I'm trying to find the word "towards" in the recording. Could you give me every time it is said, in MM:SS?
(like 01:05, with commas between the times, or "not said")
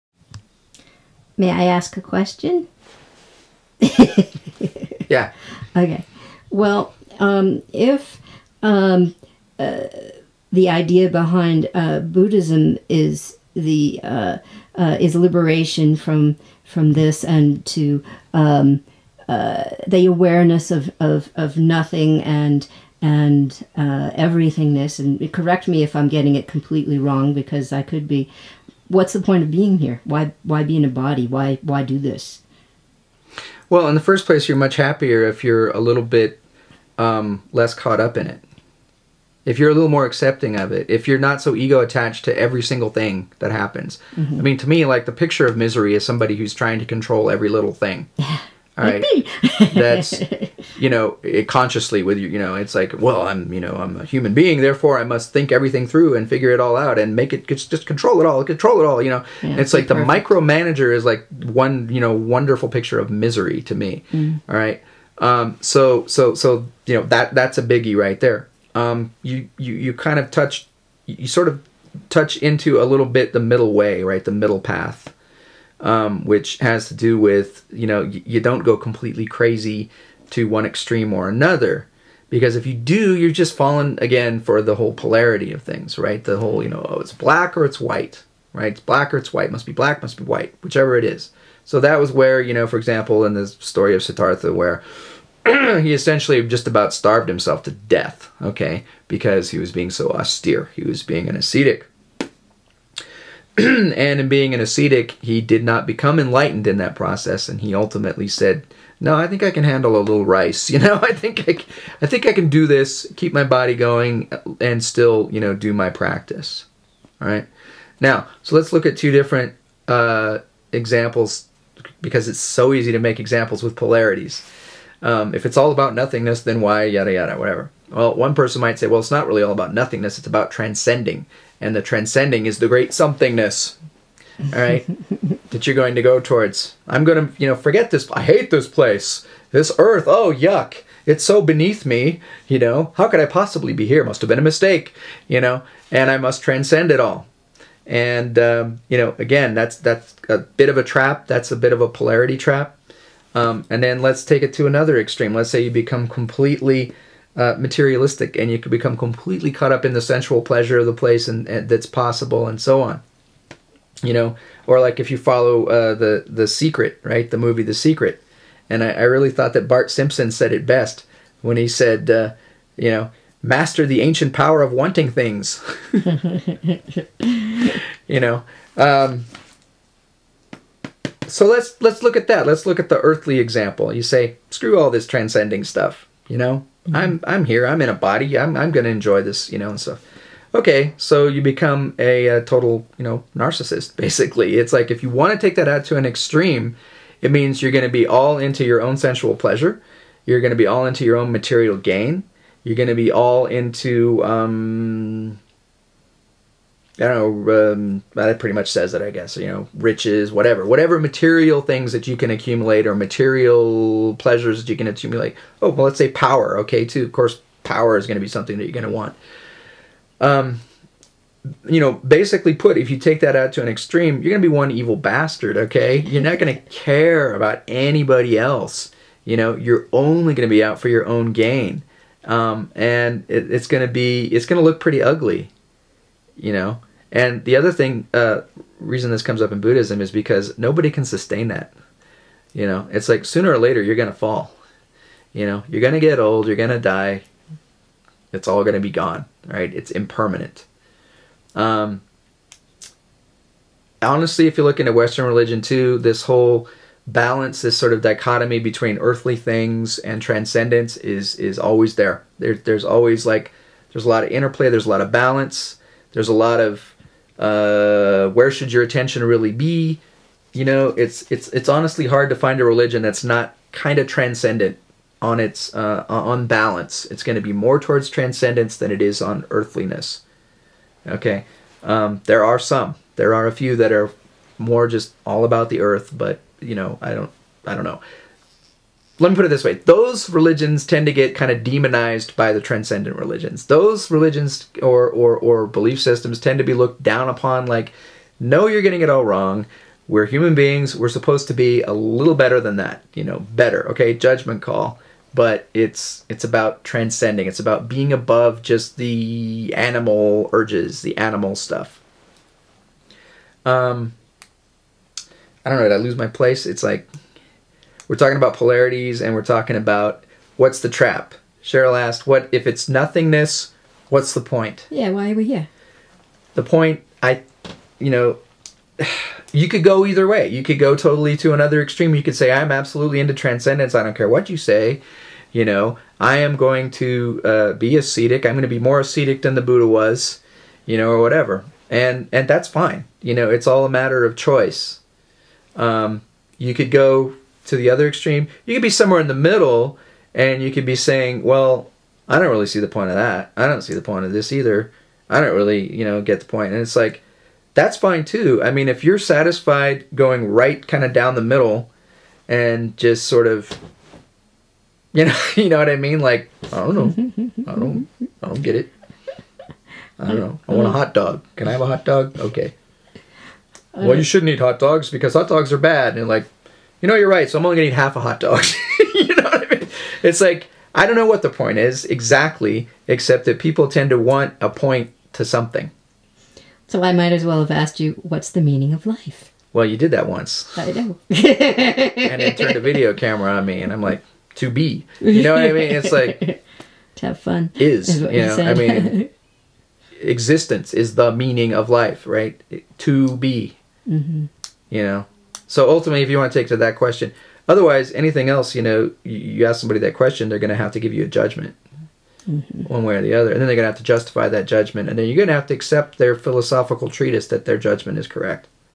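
02:16, 04:37.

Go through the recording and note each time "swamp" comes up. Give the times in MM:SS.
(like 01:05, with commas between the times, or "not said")
not said.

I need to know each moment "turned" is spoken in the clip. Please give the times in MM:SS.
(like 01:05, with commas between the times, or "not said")
06:32.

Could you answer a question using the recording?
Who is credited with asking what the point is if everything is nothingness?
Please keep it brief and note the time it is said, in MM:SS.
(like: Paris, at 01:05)
Cheryl, at 05:21.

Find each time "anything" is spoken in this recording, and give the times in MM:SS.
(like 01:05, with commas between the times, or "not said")
06:48.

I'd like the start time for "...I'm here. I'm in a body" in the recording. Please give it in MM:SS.
03:07.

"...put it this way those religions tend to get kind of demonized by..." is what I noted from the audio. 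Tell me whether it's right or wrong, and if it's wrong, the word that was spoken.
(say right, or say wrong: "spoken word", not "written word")
right.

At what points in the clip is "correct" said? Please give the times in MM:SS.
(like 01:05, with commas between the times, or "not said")
00:25, 06:58.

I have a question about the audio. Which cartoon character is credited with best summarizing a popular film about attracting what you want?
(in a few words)
Bart Simpson.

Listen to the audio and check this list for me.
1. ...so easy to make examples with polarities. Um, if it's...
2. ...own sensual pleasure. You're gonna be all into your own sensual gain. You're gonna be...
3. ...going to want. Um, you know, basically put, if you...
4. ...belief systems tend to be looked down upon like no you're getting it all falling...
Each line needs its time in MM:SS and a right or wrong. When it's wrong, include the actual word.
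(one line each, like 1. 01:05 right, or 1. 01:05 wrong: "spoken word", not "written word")
1. 02:02 right
2. 03:18 wrong: "material", not "sensual"
3. 03:38 right
4. 04:55 wrong: "wrong", not "falling".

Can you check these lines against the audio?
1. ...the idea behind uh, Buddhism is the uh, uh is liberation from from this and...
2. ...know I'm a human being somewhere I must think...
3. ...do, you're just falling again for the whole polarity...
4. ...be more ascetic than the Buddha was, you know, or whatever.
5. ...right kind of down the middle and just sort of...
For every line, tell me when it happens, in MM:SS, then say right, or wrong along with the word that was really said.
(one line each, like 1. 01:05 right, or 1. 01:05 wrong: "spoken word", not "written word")
1. 00:10 right
2. 00:53 wrong: "therefore", not "somewhere"
3. 01:22 right
4. 05:38 right
5. 06:00 right.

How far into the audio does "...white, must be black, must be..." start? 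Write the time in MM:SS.
01:29.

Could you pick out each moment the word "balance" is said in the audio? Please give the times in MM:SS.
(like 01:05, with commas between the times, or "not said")
04:17, 04:25, 04:36.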